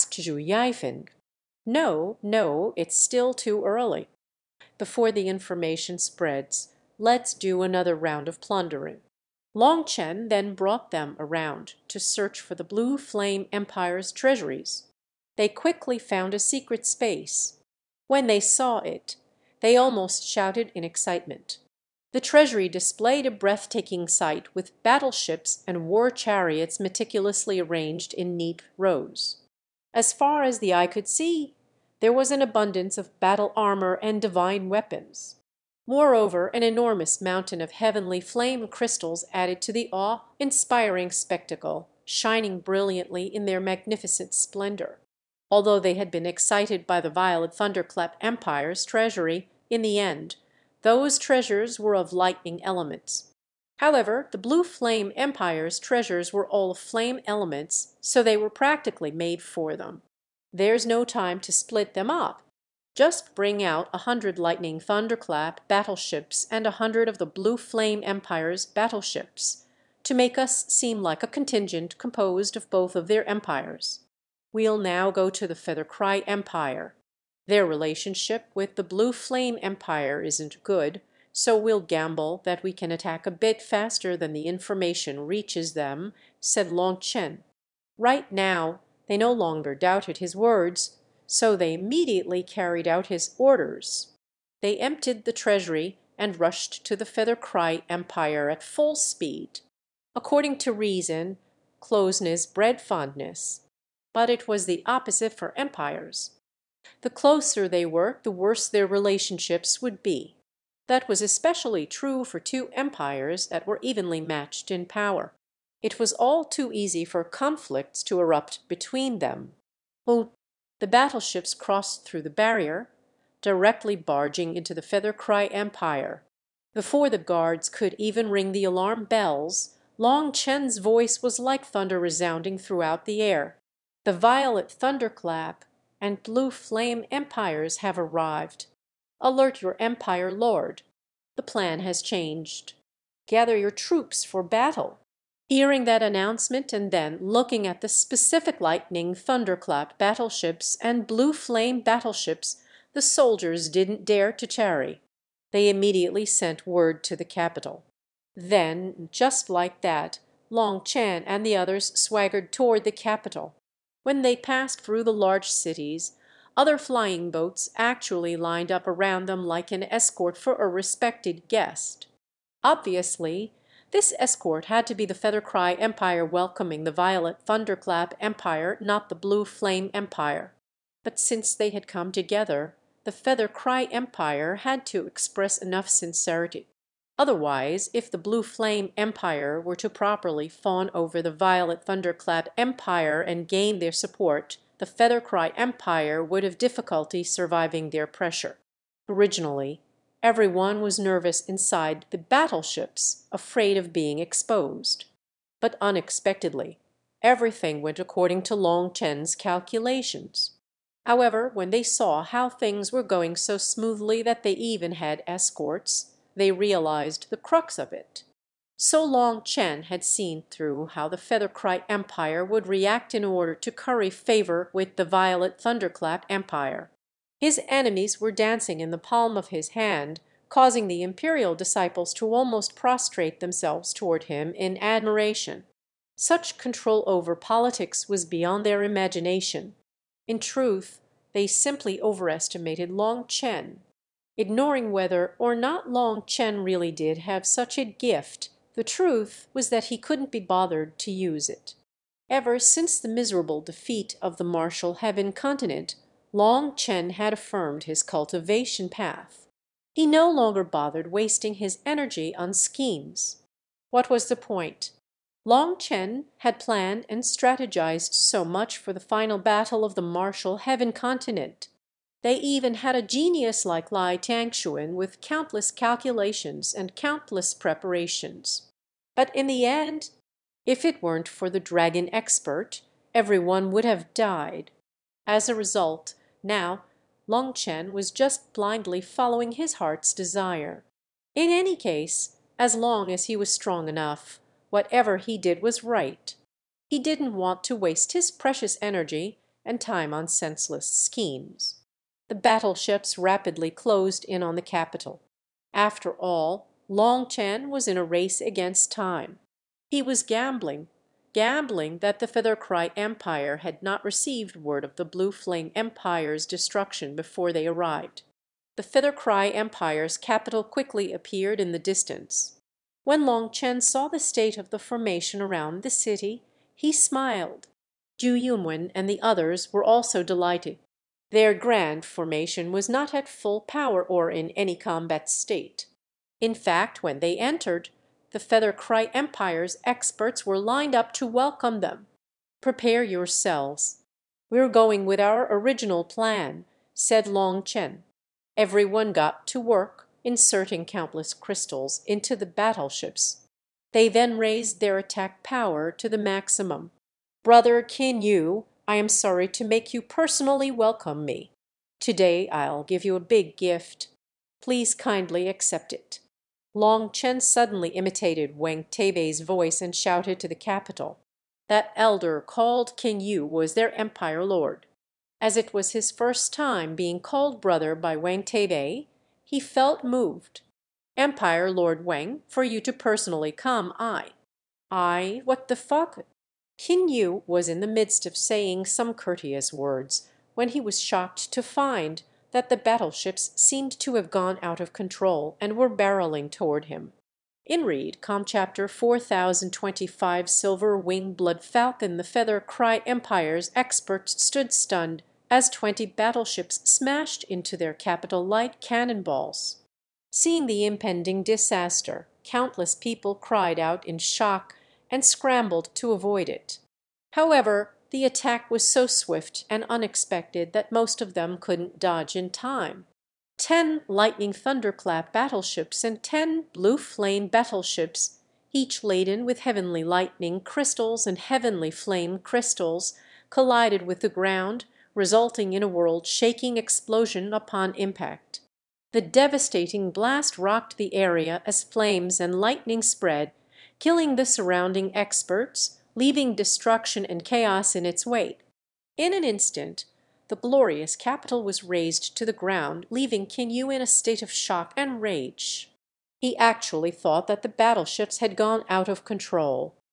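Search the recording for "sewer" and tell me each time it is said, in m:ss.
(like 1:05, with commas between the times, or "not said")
not said.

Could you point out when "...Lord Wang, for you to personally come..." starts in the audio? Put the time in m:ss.
6:21.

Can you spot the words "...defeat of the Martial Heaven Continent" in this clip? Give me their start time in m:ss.
4:13.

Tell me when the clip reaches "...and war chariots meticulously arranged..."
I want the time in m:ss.
0:25.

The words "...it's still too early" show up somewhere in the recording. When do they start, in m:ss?
0:02.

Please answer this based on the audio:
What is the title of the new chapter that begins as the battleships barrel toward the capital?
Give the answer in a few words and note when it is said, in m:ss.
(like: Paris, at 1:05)
Silver Wing Blood Falcon, at 6:40.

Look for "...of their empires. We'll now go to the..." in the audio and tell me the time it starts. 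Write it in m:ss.
1:12.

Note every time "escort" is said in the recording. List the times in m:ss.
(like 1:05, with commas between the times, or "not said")
2:49, 2:54, 3:35.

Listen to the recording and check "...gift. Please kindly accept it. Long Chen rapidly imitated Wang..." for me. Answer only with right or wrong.
wrong.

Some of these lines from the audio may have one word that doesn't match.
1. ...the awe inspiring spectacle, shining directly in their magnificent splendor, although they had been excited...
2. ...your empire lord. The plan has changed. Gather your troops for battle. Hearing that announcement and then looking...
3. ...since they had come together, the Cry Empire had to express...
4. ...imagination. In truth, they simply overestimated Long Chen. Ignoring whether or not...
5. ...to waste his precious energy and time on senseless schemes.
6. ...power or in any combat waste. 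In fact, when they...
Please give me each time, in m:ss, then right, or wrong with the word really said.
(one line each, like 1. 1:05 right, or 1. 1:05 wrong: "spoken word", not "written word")
1. 0:39 wrong: "brilliantly", not "directly"
2. 2:19 right
3. 3:01 right
4. 3:58 right
5. 4:57 right
6. 5:33 wrong: "state", not "waste".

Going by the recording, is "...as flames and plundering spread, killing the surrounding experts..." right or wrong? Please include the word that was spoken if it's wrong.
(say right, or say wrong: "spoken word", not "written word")
wrong: "lightning", not "plundering".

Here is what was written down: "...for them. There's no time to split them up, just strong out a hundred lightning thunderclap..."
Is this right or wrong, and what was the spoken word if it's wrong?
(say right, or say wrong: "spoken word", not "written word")
wrong: "bring", not "strong".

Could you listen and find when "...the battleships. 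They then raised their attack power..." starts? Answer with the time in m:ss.
5:52.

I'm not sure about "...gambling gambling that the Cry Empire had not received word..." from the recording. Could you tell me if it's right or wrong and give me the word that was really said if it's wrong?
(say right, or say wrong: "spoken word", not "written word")
right.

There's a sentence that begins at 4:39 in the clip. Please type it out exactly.
But in the end, if it weren't for the dragon expert, everyone would have died.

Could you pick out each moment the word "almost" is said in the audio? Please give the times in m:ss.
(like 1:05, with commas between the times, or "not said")
0:19, 3:52.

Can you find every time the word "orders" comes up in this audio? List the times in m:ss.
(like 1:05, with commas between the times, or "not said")
1:33, 3:43.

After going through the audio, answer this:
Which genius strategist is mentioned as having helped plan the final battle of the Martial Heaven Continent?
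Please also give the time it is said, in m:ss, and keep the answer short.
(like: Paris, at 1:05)
Lai Tangsuan, at 4:33.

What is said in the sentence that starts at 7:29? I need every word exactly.
In an instant the glorious capital was razed to the ground, leaving Qin Yu in a state of shock and rage.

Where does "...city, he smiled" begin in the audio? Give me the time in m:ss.
5:25.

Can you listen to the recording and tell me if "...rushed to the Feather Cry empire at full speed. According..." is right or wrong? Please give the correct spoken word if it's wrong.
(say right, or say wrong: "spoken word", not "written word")
right.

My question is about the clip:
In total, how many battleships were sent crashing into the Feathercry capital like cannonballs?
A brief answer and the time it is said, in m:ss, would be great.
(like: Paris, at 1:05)
20, at 6:45.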